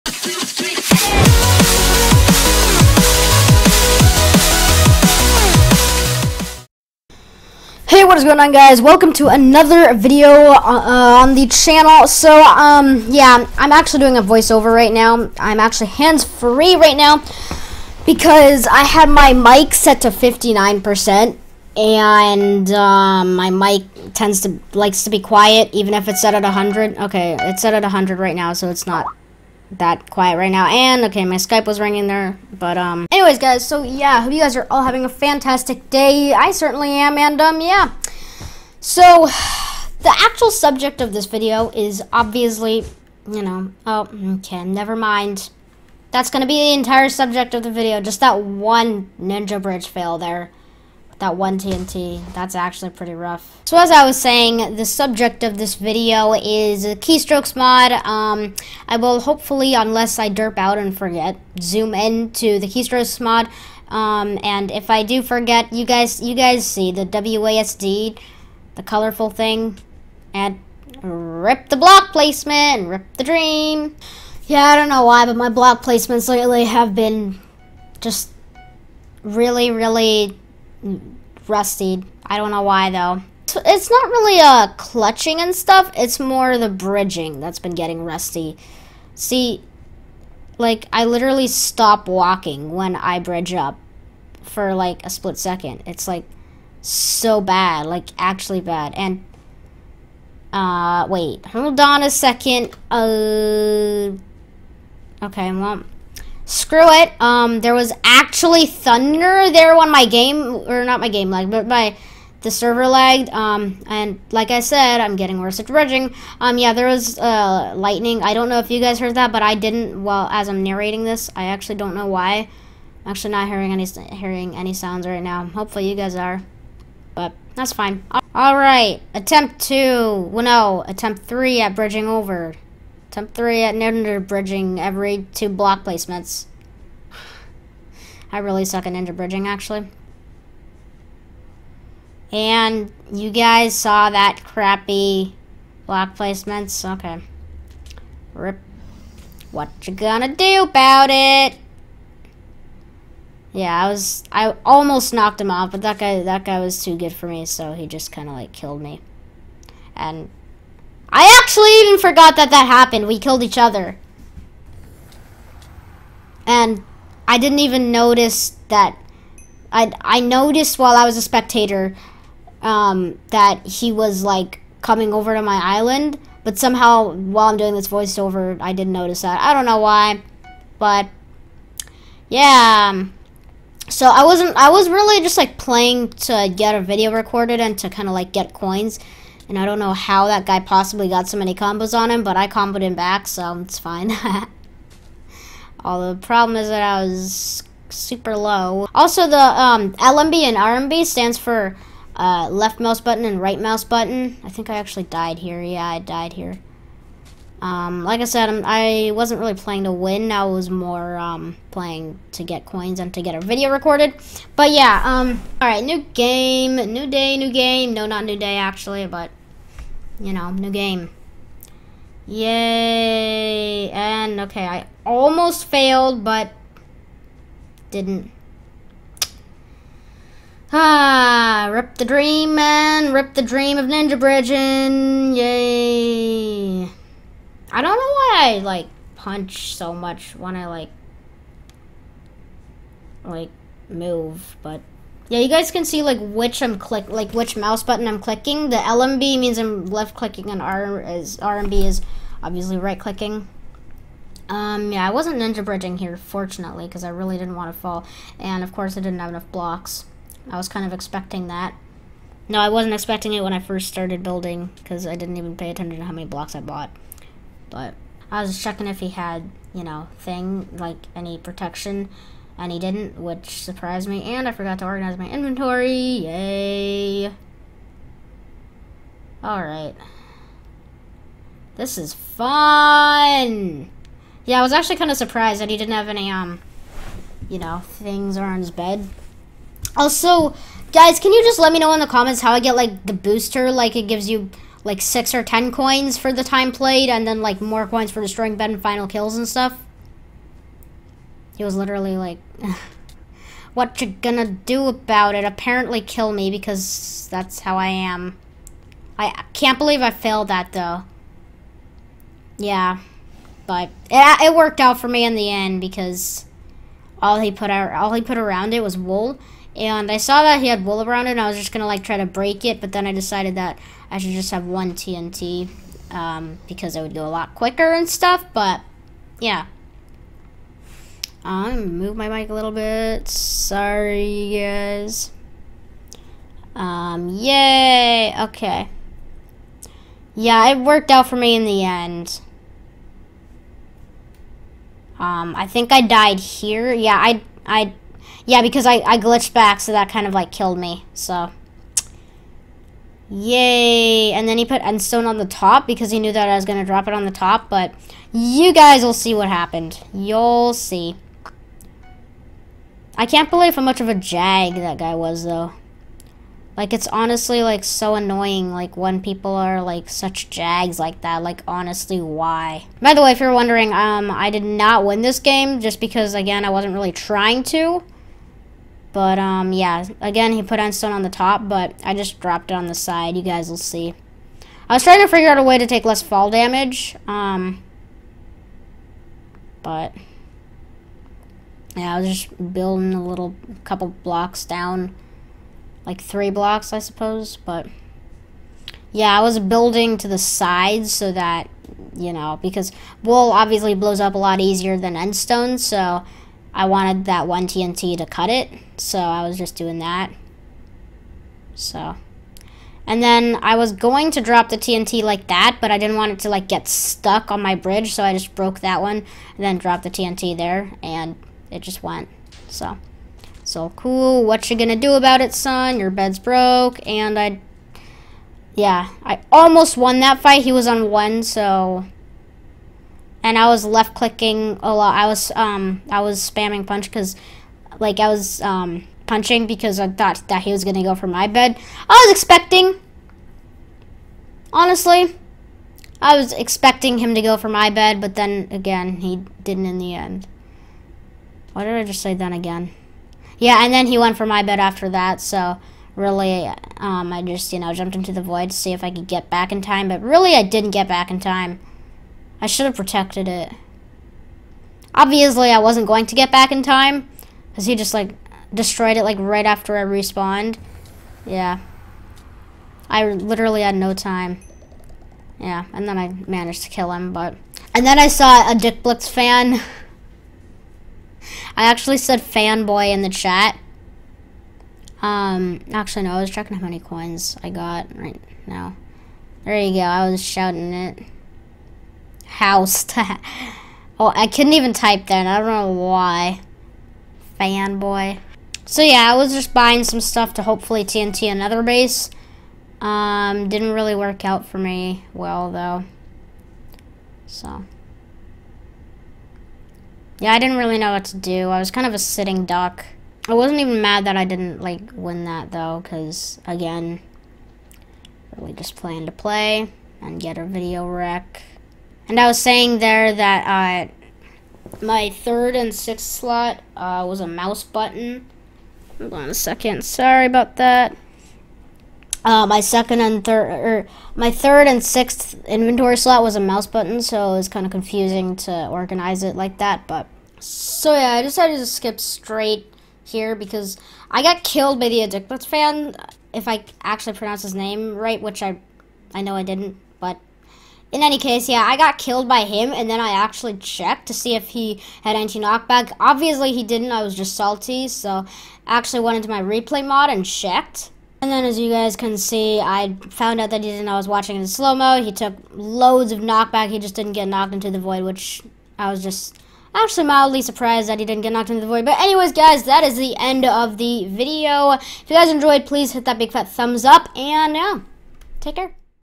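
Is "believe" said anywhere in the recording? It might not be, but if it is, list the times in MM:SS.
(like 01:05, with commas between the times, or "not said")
05:09, 06:03.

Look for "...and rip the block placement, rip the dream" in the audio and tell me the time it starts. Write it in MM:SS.
01:10.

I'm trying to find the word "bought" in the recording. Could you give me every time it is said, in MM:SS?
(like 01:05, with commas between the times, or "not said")
04:26.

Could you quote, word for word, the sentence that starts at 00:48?
Just that one Ninja Bridge fail there that one TNT.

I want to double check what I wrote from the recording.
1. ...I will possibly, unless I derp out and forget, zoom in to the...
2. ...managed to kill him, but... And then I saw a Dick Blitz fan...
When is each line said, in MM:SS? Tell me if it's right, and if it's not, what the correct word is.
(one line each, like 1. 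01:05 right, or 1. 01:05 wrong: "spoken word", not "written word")
1. 00:58 wrong: "hopefully", not "possibly"
2. 07:56 right.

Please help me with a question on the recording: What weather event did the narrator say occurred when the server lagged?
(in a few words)
Thunder.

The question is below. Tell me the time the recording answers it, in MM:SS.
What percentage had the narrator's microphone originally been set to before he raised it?
00:20.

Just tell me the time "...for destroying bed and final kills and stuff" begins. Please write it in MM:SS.
04:58.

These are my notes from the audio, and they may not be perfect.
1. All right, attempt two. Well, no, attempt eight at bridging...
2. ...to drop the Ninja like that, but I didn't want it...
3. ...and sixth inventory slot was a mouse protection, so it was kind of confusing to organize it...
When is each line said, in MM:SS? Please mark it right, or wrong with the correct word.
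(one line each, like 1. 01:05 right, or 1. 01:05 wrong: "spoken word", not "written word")
1. 02:08 wrong: "three", not "eight"
2. 06:54 wrong: "TNT", not "Ninja"
3. 08:54 wrong: "button", not "protection".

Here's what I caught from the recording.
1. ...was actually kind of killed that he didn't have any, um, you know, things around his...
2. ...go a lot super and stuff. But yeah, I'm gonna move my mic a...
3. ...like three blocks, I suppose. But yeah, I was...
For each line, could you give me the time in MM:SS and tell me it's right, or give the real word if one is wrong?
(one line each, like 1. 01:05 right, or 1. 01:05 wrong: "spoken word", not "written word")
1. 04:44 wrong: "surprised", not "killed"
2. 05:27 wrong: "quicker", not "super"
3. 06:36 right.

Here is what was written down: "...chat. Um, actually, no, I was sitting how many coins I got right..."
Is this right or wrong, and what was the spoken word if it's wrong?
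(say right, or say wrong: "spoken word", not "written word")
wrong: "checking", not "sitting".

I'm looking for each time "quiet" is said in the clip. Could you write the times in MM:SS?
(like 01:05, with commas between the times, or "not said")
00:25, 00:30.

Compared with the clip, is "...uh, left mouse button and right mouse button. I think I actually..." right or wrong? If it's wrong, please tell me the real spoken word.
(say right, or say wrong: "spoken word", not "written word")
right.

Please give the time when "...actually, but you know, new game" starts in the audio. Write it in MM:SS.
03:38.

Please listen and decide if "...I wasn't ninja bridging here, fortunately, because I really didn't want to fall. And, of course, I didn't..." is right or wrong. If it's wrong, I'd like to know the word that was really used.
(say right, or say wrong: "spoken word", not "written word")
right.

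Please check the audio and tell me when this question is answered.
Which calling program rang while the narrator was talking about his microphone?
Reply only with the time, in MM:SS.
00:31.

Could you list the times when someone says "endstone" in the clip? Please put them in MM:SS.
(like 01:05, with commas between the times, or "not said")
05:54, 06:20.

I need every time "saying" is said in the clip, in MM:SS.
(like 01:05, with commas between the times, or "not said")
00:54, 08:42.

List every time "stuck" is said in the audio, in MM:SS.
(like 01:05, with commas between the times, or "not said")
06:56.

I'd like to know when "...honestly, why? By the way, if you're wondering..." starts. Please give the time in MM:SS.
06:11.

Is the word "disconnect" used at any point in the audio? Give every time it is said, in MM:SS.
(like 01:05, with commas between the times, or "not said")
not said.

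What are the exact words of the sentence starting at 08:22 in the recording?
Um, didn't really work out for me well, though.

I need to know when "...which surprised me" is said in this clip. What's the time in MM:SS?
04:33.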